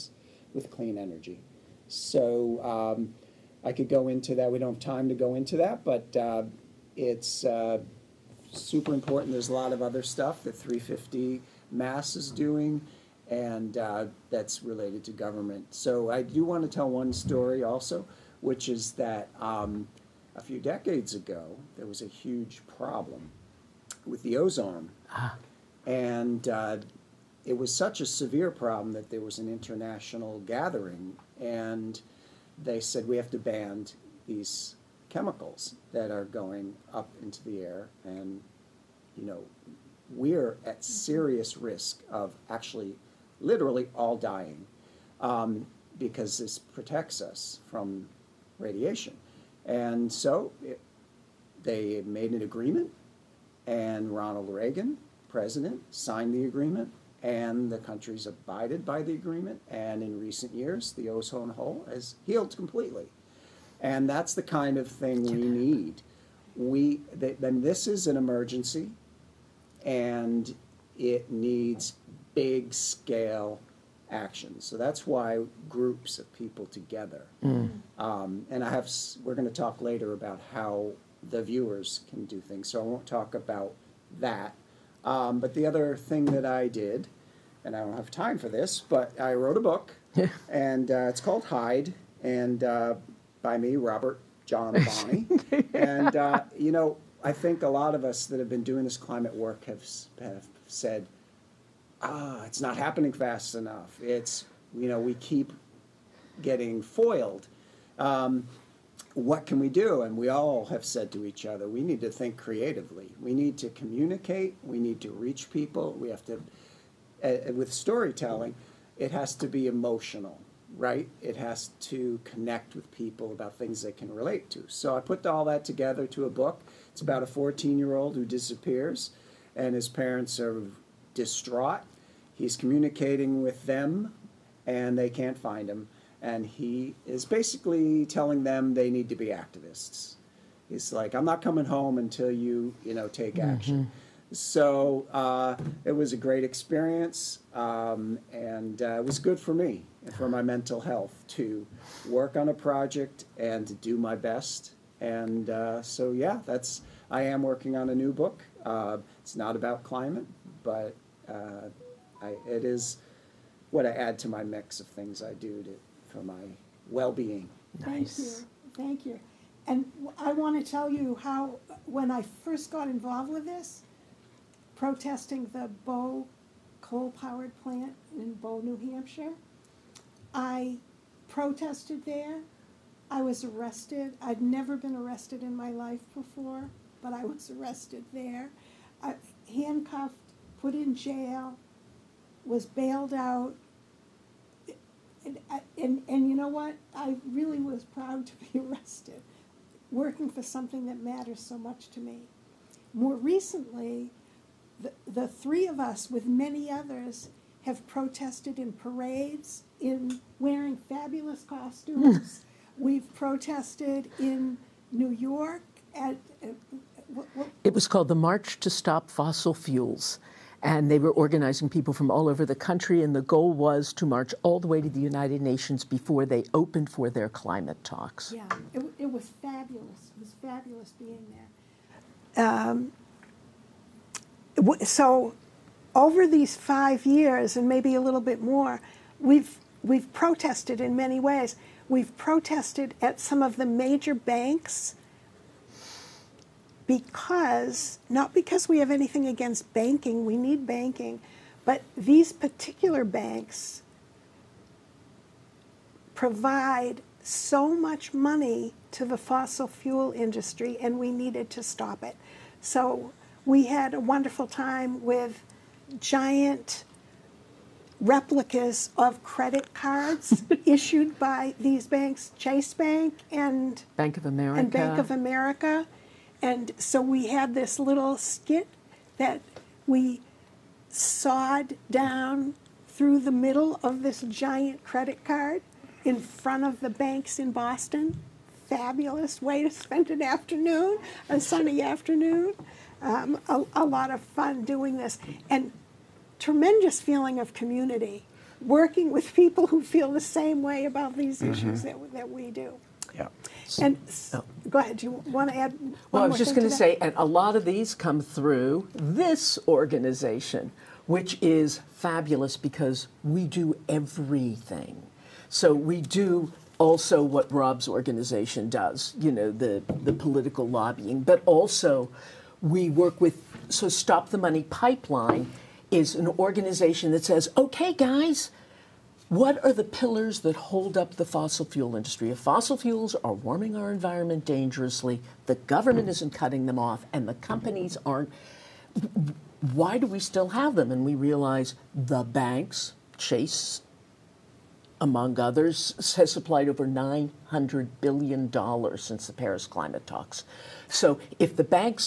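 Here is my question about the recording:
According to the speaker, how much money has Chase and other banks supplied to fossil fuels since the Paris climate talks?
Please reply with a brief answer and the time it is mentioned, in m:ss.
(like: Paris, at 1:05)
over $900 billion, at 5:46.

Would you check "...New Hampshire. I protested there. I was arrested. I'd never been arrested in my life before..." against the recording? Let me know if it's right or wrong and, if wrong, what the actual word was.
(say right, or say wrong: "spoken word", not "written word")
right.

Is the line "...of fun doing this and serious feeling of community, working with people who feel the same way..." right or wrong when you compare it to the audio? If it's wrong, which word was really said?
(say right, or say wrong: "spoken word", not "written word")
wrong: "tremendous", not "serious".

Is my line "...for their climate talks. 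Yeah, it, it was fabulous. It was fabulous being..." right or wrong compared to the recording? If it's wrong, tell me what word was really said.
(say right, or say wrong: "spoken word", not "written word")
right.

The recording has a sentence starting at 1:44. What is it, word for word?
It's you know we keep getting foiled.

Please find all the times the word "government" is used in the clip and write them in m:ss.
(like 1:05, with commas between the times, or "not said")
0:15, 5:35.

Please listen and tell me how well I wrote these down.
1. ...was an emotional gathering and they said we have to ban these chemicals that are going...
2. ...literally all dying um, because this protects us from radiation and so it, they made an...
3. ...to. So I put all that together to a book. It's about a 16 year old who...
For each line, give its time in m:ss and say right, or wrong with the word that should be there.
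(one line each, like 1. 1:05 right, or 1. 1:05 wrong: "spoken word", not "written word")
1. 0:29 wrong: "international", not "emotional"
2. 0:43 right
3. 2:04 wrong: "14", not "16".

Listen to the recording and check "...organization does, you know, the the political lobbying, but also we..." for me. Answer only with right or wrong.
right.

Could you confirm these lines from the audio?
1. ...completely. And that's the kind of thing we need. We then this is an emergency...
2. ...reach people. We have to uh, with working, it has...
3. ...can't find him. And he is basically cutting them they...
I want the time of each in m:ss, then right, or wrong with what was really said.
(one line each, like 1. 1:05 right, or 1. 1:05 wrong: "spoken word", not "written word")
1. 1:02 right
2. 1:55 wrong: "storytelling", not "working"
3. 2:15 wrong: "telling", not "cutting".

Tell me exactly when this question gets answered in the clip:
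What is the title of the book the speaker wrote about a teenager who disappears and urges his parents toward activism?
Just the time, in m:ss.
1:31.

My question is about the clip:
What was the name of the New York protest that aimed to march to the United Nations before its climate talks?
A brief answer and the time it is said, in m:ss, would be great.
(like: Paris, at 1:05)
March to Stop Fossil Fuels, at 3:38.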